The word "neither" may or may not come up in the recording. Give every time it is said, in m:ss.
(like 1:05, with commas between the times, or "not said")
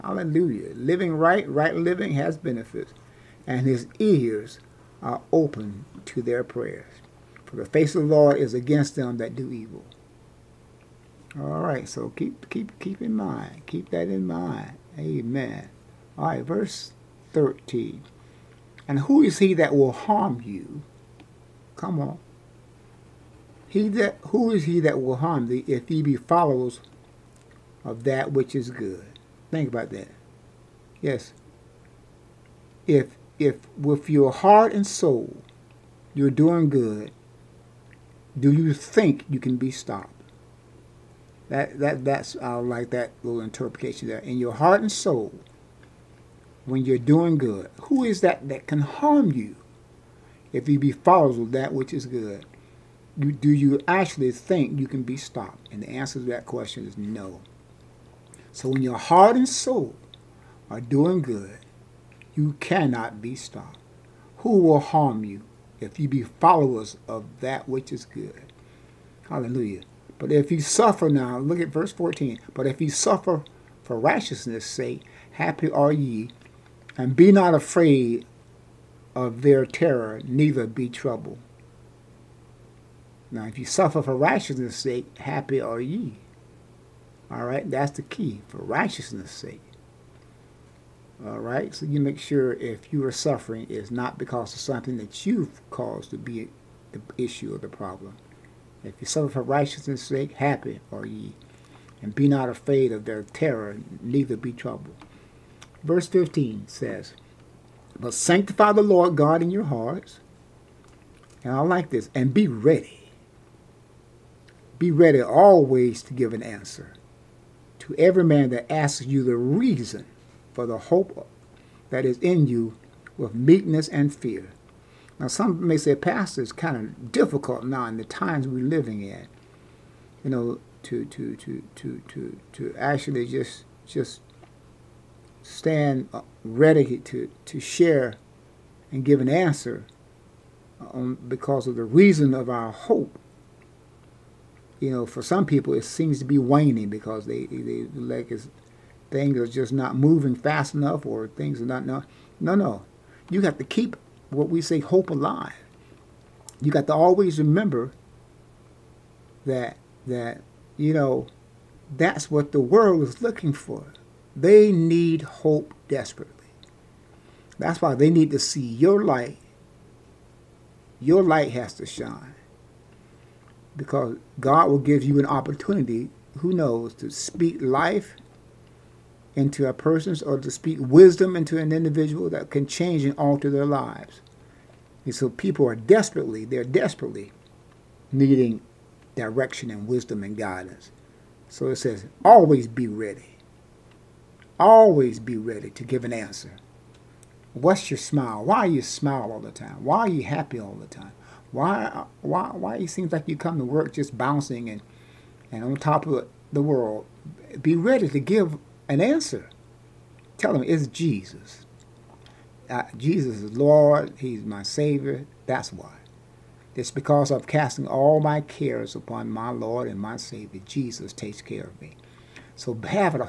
1:20, 1:44.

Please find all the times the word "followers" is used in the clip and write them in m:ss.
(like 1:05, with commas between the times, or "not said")
0:26, 0:50, 1:06.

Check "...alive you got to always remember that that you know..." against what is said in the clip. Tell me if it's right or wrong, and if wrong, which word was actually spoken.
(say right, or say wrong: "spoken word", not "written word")
right.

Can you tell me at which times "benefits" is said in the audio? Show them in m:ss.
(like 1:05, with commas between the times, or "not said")
0:02.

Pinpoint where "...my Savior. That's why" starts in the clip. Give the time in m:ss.
3:34.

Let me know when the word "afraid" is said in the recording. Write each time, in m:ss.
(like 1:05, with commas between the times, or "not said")
1:17, 1:42.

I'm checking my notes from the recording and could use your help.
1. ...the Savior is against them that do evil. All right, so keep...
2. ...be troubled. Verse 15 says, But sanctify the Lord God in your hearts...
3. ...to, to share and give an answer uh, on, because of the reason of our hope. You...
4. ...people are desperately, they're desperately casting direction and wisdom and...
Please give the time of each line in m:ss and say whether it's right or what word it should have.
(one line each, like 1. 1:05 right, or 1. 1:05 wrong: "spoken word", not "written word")
1. 0:08 wrong: "Lord", not "Savior"
2. 1:44 right
3. 2:16 right
4. 3:05 wrong: "needing", not "casting".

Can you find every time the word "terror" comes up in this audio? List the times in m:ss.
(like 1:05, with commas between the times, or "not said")
1:19, 1:43.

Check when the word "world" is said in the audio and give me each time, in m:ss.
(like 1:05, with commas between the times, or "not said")
2:42, 3:26.